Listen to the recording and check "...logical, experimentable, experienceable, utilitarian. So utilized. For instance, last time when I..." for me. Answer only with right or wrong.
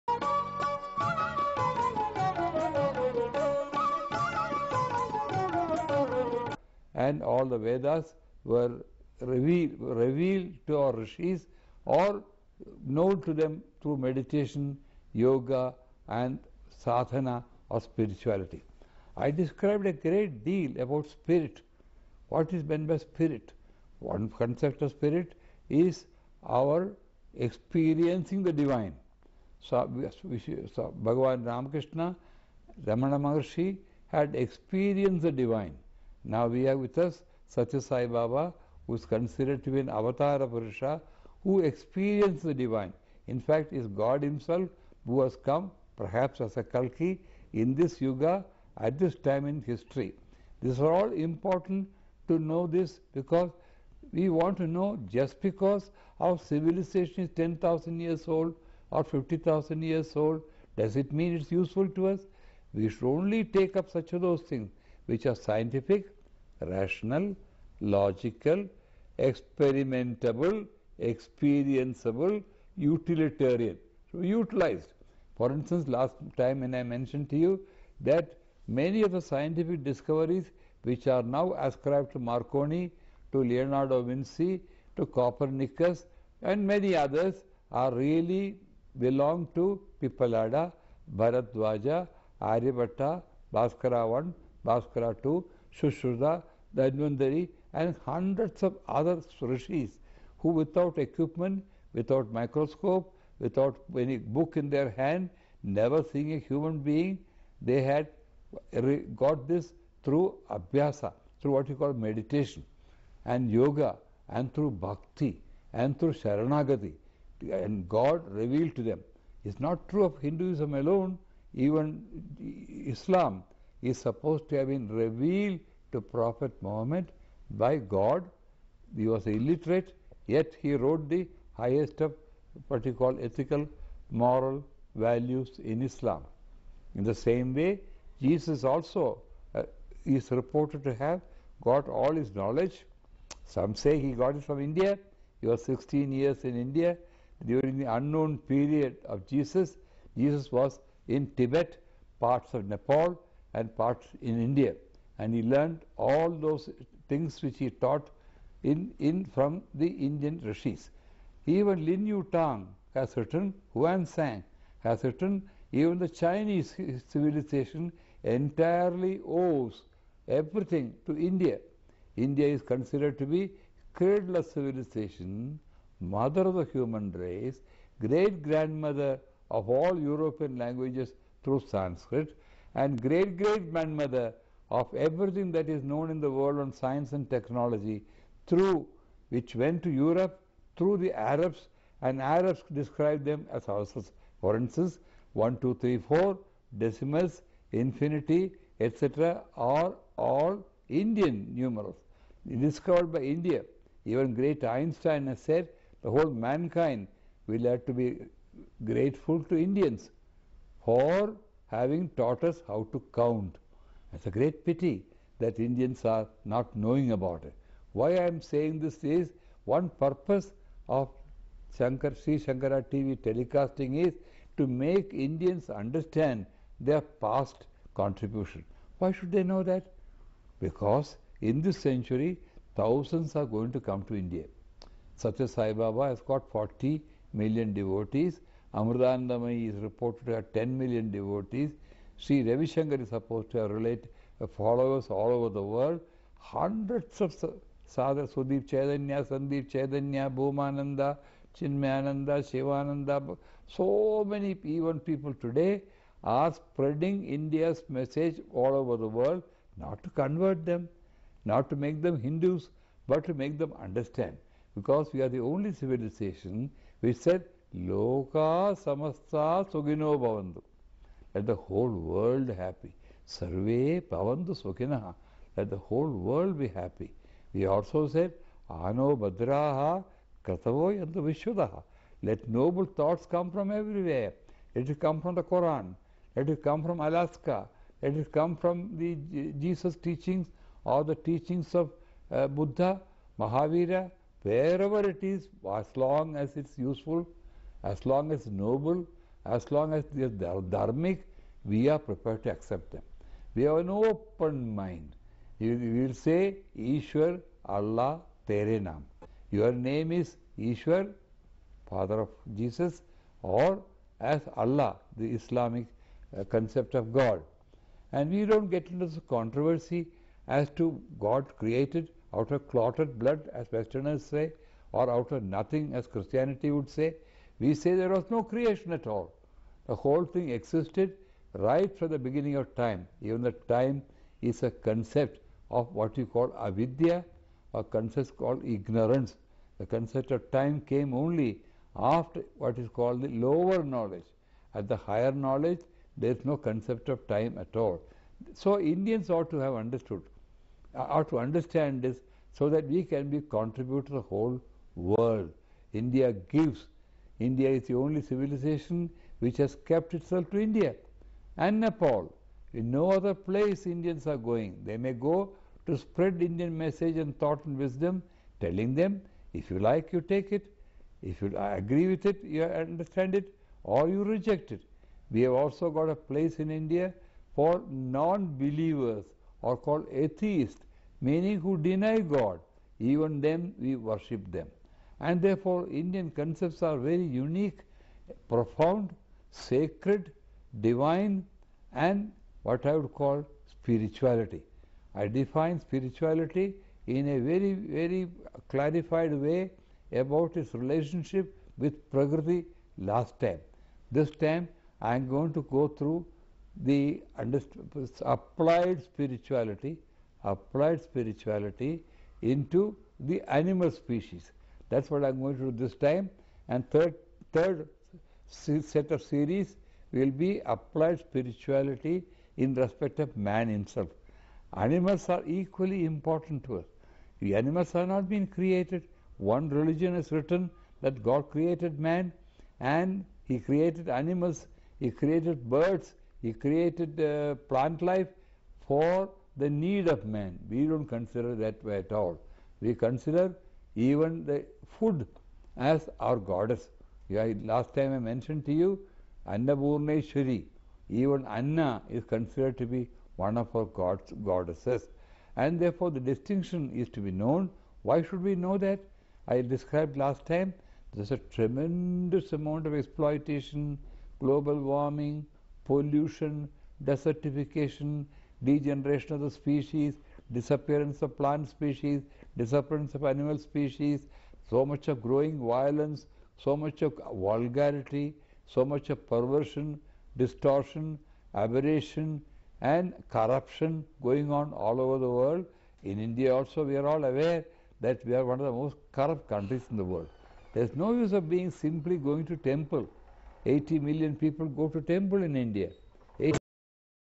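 right.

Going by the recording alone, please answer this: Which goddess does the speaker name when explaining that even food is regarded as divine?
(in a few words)
Annapurneshwari.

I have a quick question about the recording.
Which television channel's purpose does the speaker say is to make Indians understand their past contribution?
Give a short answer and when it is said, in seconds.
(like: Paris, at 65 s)
Sri Shankara TV, at 222 s.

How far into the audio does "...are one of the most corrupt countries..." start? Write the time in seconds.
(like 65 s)
488 s.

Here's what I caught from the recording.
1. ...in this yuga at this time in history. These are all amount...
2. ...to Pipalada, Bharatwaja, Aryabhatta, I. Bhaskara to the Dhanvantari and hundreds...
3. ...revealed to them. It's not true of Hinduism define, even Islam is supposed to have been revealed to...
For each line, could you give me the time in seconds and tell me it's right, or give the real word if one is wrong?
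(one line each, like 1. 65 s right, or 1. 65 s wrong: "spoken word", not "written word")
1. 47 s wrong: "important", not "amount"
2. 89 s right
3. 118 s wrong: "alone", not "define".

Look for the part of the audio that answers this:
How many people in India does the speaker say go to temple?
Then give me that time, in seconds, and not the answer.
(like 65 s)
493 s.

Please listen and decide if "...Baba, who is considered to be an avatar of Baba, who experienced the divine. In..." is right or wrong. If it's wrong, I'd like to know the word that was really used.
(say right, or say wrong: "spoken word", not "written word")
wrong: "Purusha", not "Baba".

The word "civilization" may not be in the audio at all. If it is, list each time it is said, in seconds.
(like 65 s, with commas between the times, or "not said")
56 s, 167 s, 174 s, 265 s, 358 s.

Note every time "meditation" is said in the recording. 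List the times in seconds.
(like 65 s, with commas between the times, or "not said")
14 s, 111 s.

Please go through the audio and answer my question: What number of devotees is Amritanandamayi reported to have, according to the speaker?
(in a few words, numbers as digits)
10 million.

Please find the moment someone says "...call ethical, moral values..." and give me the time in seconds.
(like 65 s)
132 s.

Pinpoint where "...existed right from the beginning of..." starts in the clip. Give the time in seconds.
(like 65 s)
330 s.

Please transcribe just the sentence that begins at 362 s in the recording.
In no other place Indians are going.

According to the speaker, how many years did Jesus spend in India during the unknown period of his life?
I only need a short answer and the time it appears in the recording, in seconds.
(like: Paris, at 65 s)
16, at 145 s.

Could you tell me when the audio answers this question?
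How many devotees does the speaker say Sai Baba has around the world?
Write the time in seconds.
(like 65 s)
236 s.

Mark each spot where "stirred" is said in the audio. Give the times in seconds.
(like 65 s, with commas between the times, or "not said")
not said.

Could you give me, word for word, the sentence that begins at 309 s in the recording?
Your name is Ishwar, Father of Jesus, or as Allah, the Islamic uh, concept of God.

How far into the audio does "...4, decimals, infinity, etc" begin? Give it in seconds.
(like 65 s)
195 s.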